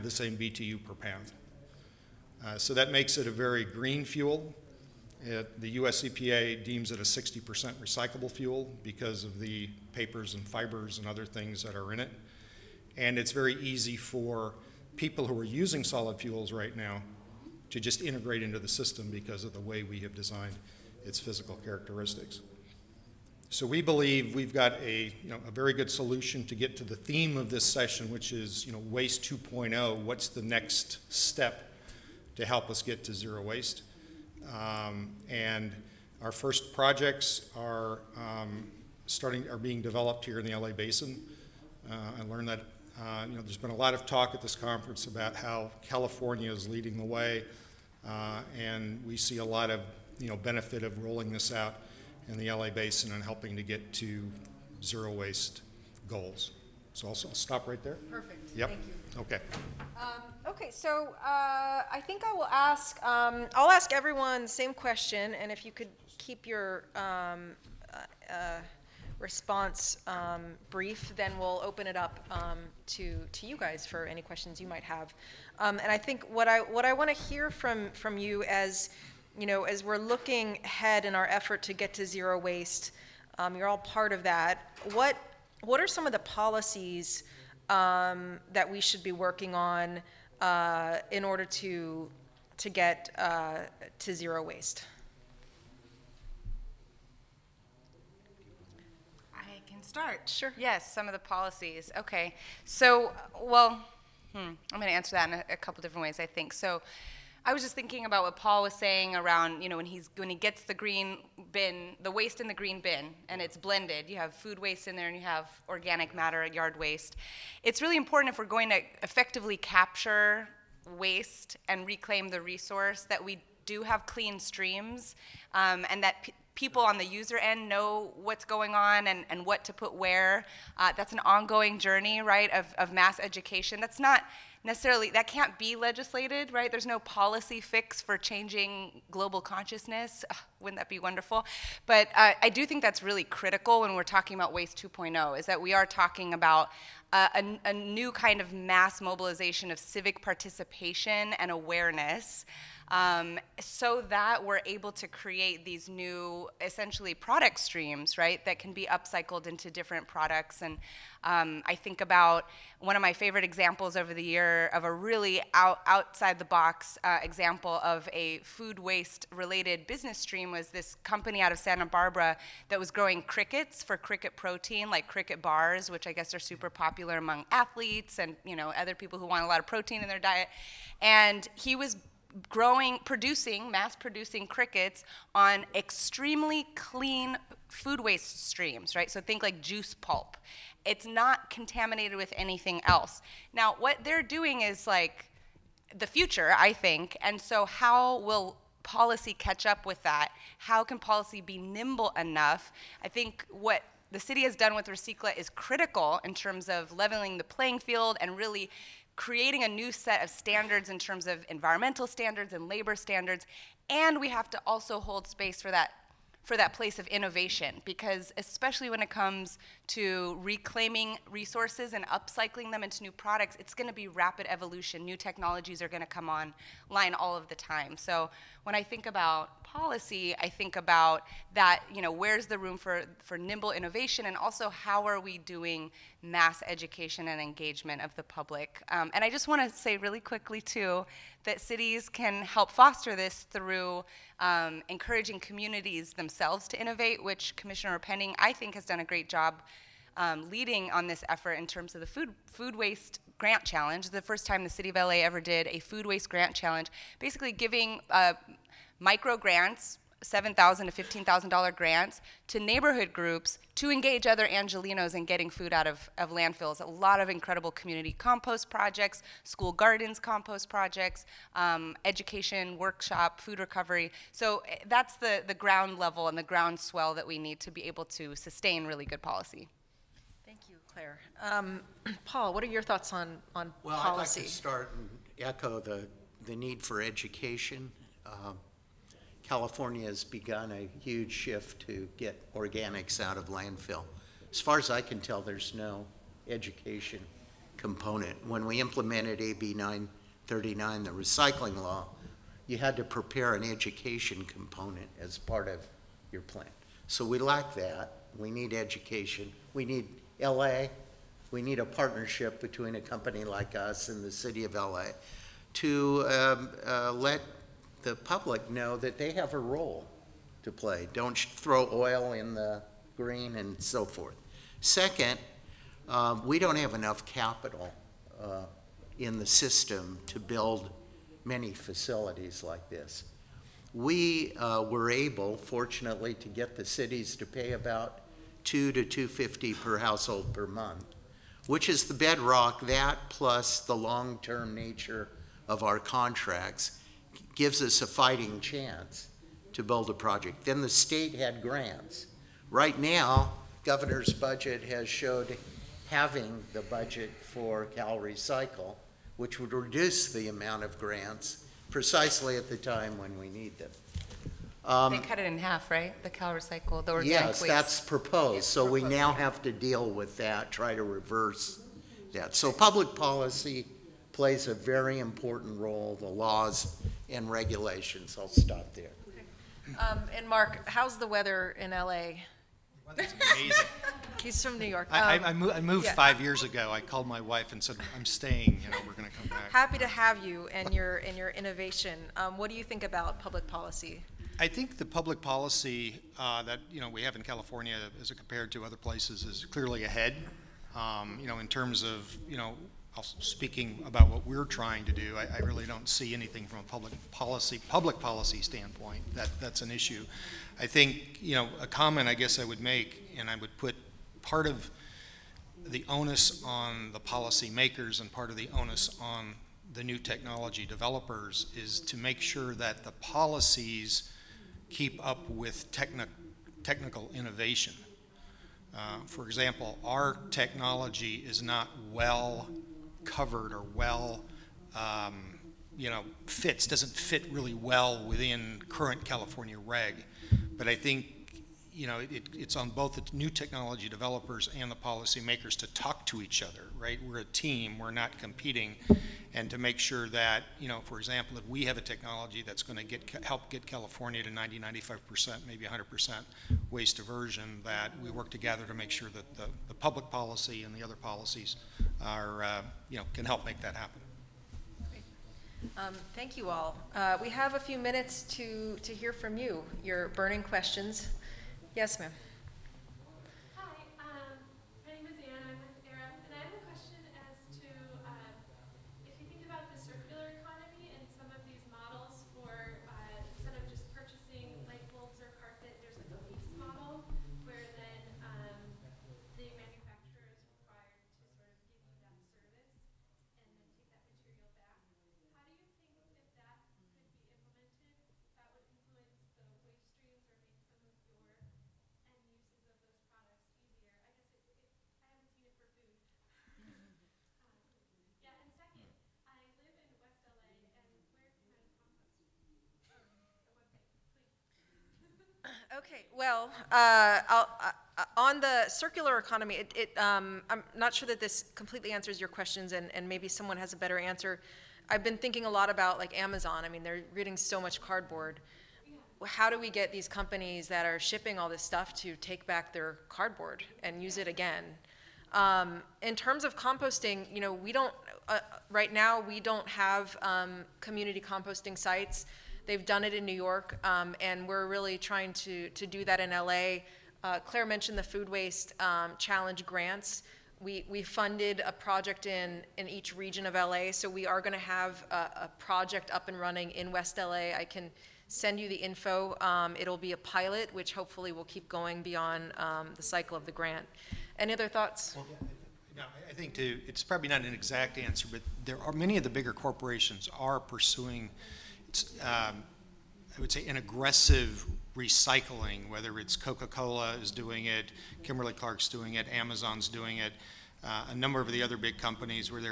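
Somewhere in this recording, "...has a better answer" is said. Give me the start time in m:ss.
8:43.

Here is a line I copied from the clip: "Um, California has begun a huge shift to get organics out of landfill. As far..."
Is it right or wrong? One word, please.
right.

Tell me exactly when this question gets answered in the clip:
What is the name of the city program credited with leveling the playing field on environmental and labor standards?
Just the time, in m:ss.
3:24.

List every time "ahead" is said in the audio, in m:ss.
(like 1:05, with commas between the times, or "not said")
1:20, 6:40.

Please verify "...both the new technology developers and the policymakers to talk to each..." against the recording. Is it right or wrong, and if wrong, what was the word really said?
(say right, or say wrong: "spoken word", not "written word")
right.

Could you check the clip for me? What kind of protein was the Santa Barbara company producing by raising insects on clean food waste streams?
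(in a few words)
Cricket protein.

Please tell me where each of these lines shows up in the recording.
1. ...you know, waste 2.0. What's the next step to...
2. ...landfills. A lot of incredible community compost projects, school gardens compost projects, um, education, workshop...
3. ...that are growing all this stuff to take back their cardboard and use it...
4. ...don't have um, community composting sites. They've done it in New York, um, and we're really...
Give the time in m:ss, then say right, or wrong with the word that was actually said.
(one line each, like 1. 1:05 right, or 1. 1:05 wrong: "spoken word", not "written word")
1. 0:28 right
2. 4:26 right
3. 8:50 wrong: "shipping", not "growing"
4. 8:59 right.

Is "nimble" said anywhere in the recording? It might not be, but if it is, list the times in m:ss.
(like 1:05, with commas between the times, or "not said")
3:21, 3:53.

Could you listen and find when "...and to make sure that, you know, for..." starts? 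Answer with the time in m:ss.
7:29.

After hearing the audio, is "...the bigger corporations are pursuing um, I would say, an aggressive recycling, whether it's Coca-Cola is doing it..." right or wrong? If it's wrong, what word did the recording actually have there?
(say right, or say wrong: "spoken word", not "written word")
right.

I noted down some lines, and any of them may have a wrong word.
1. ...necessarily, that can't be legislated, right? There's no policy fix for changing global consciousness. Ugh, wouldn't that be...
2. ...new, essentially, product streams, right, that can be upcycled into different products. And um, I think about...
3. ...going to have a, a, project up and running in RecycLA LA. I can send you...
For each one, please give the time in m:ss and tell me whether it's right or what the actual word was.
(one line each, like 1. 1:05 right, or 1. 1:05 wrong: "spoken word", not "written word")
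1. 2:14 right
2. 2:35 right
3. 9:14 wrong: "West", not "RecycLA".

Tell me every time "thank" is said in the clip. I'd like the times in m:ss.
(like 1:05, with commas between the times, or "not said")
0:58, 4:40, 7:46.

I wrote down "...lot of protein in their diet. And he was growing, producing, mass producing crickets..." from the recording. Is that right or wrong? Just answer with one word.
right.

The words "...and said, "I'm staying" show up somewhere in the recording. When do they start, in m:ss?
6:27.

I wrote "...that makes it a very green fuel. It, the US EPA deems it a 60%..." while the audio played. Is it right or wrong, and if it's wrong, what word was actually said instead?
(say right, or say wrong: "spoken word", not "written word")
right.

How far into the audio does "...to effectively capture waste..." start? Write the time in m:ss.
1:58.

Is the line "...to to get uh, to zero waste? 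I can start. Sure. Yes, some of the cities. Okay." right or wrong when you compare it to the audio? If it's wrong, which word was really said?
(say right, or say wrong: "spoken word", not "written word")
wrong: "policies", not "cities".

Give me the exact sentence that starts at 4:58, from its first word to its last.
When we implemented AB 939, the recycling law, you had to prepare an education component as part of your plan.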